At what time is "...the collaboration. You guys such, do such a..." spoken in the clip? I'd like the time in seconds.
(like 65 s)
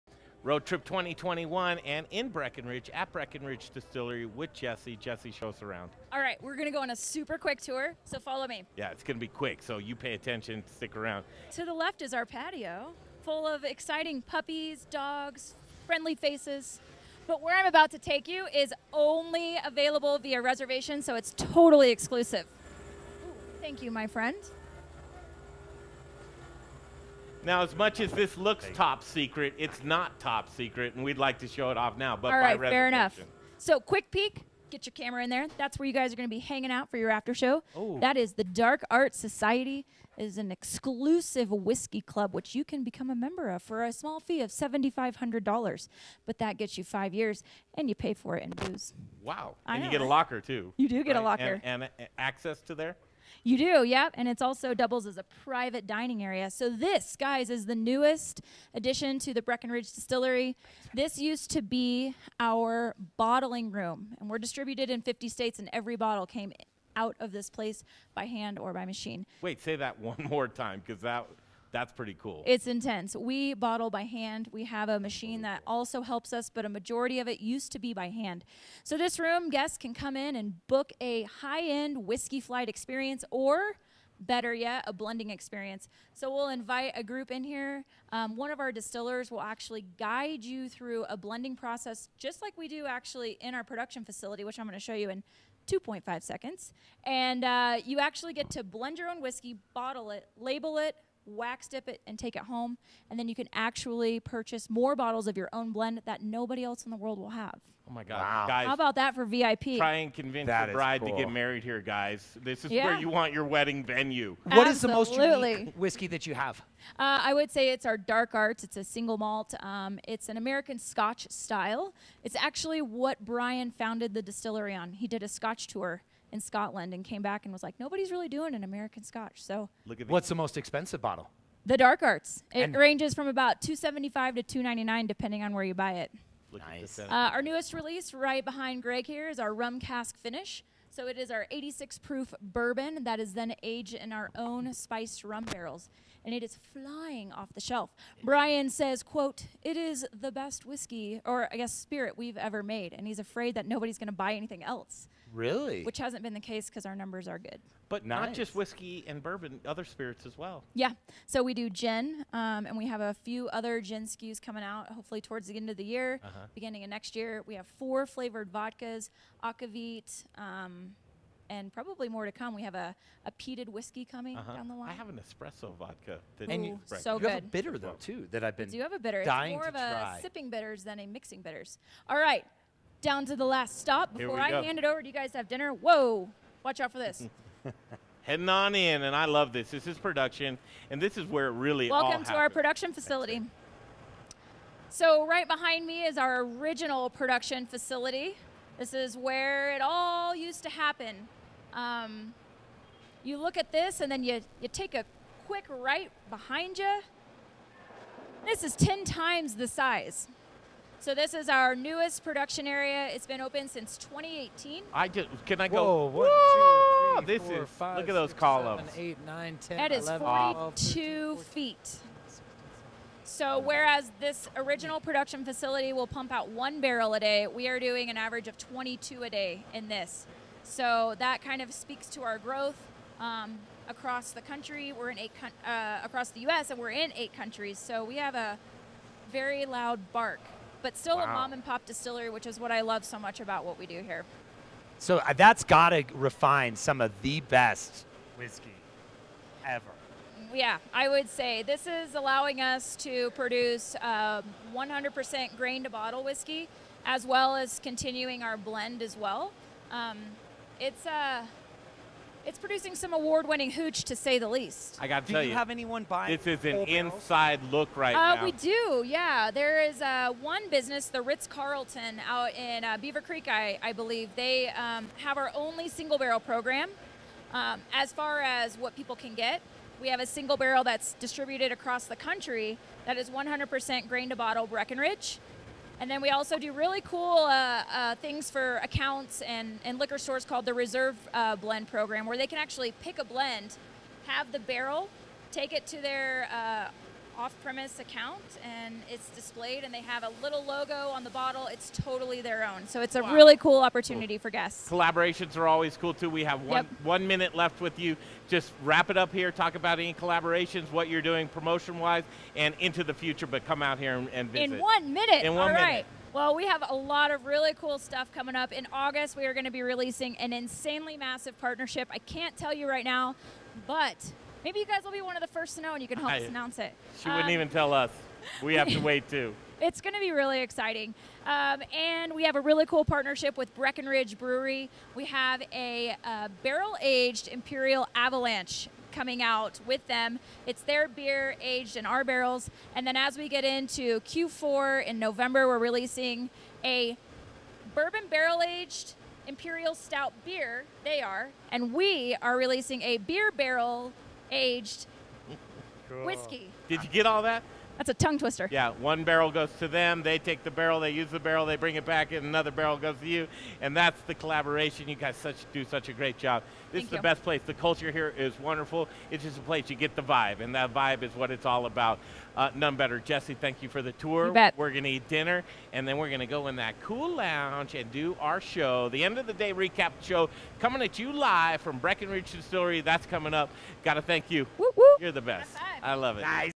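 364 s.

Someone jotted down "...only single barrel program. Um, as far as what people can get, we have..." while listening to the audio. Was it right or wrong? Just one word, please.
right.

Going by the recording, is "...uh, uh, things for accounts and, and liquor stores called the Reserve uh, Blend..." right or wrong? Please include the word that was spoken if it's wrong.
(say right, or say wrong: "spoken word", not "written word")
right.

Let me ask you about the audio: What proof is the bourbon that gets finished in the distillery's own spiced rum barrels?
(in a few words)
86.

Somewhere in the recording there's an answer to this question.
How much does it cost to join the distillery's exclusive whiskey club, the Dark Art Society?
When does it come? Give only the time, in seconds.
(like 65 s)
44 s.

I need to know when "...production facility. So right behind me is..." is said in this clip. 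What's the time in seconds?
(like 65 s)
192 s.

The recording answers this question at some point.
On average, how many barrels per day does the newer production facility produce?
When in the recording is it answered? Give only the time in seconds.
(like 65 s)
228 s.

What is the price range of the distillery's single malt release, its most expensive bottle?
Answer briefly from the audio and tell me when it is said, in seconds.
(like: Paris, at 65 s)
275 to 299, at 133 s.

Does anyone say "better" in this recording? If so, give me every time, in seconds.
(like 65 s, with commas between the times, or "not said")
84 s, 372 s.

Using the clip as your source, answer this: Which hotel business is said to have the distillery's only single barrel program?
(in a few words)
Ritz Carlton.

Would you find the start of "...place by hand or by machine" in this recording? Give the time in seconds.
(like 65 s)
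67 s.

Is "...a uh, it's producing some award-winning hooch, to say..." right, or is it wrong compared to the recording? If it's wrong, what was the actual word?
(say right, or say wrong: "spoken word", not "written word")
right.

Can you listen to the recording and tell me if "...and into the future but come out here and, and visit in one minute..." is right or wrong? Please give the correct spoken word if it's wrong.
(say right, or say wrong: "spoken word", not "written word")
right.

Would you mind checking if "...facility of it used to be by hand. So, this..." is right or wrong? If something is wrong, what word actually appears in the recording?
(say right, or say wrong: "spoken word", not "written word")
wrong: "majority", not "facility".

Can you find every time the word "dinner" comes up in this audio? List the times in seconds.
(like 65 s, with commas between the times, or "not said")
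185 s, 375 s.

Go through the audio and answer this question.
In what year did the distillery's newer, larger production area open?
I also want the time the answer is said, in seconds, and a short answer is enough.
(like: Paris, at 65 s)
2018, at 213 s.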